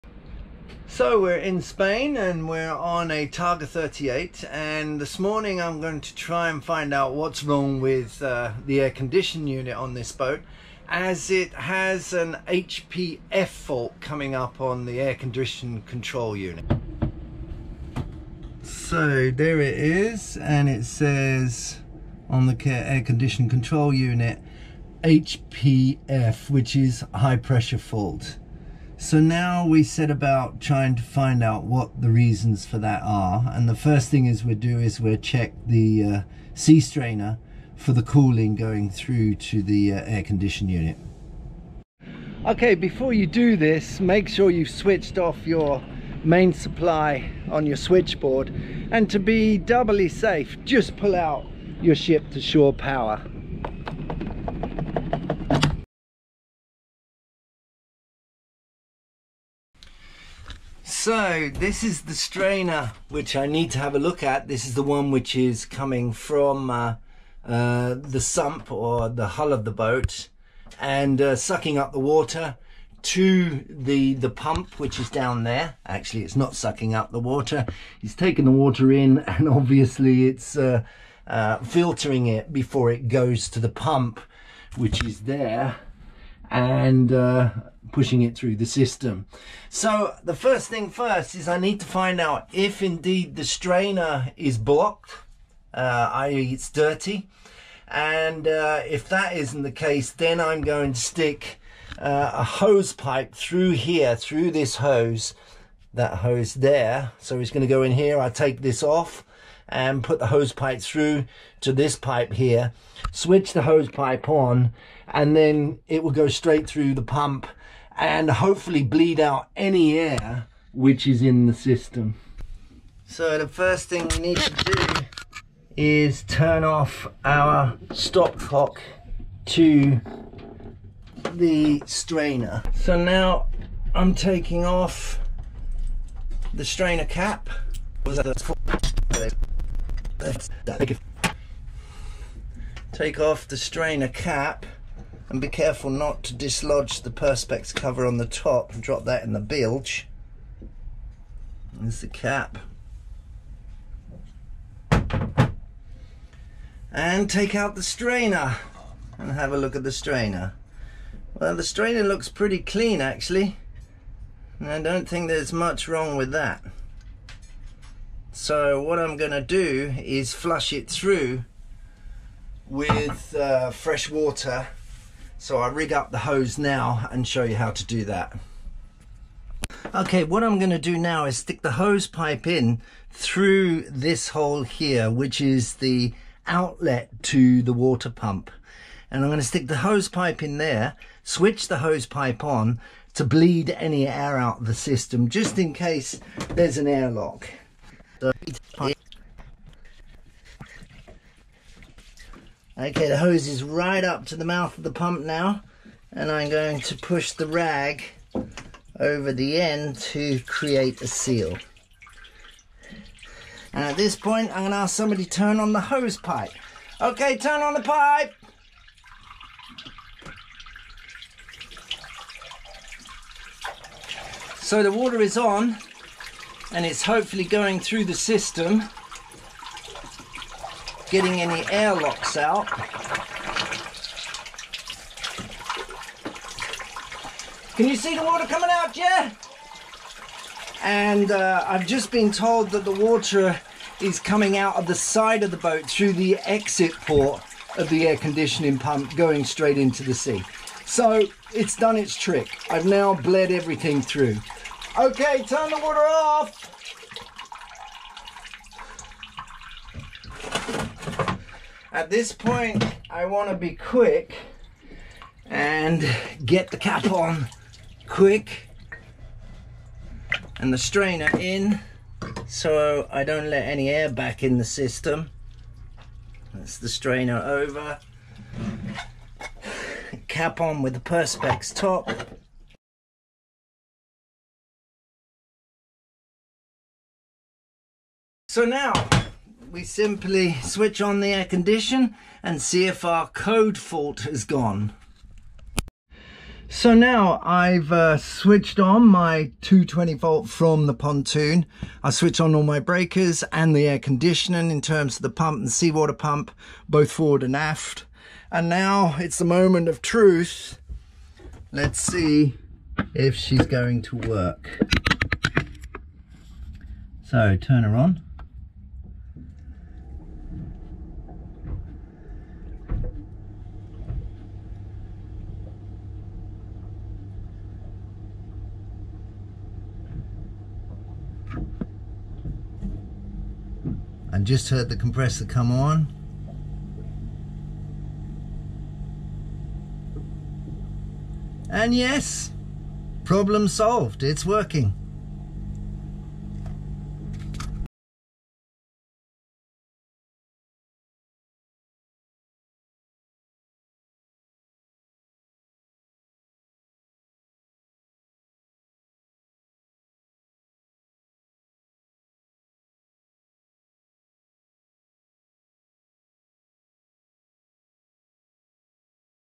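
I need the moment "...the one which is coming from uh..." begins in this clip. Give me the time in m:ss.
1:04.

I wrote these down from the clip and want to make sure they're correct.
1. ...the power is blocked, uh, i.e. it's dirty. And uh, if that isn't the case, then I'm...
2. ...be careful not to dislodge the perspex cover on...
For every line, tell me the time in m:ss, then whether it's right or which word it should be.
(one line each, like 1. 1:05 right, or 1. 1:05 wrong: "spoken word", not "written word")
1. 1:33 wrong: "strainer", not "power"
2. 2:25 right.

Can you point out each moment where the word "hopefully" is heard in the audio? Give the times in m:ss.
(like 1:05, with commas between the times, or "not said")
1:58, 3:47.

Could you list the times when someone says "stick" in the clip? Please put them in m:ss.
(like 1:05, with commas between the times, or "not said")
1:40, 3:01, 3:09.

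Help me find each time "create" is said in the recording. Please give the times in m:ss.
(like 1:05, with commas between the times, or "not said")
3:30.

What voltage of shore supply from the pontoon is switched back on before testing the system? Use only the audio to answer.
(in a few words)
220 volt.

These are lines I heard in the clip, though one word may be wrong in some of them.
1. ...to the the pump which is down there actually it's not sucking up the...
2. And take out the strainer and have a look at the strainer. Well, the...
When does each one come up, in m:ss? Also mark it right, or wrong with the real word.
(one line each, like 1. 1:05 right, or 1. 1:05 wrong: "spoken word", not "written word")
1. 1:13 right
2. 2:36 right.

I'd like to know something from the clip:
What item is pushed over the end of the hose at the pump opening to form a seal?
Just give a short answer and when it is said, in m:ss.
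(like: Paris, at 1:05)
rag, at 3:27.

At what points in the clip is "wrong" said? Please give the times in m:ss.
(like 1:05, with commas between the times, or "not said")
0:07, 2:45.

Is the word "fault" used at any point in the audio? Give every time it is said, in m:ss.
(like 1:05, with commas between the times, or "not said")
0:13, 0:27, 4:53.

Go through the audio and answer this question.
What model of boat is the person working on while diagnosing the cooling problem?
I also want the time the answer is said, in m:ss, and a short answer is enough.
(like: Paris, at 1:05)
Targa 38, at 0:03.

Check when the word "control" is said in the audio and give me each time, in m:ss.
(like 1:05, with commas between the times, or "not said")
0:15, 0:23.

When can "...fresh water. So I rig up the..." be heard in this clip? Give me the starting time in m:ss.
2:53.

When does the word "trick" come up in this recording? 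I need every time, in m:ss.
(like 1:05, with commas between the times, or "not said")
4:12.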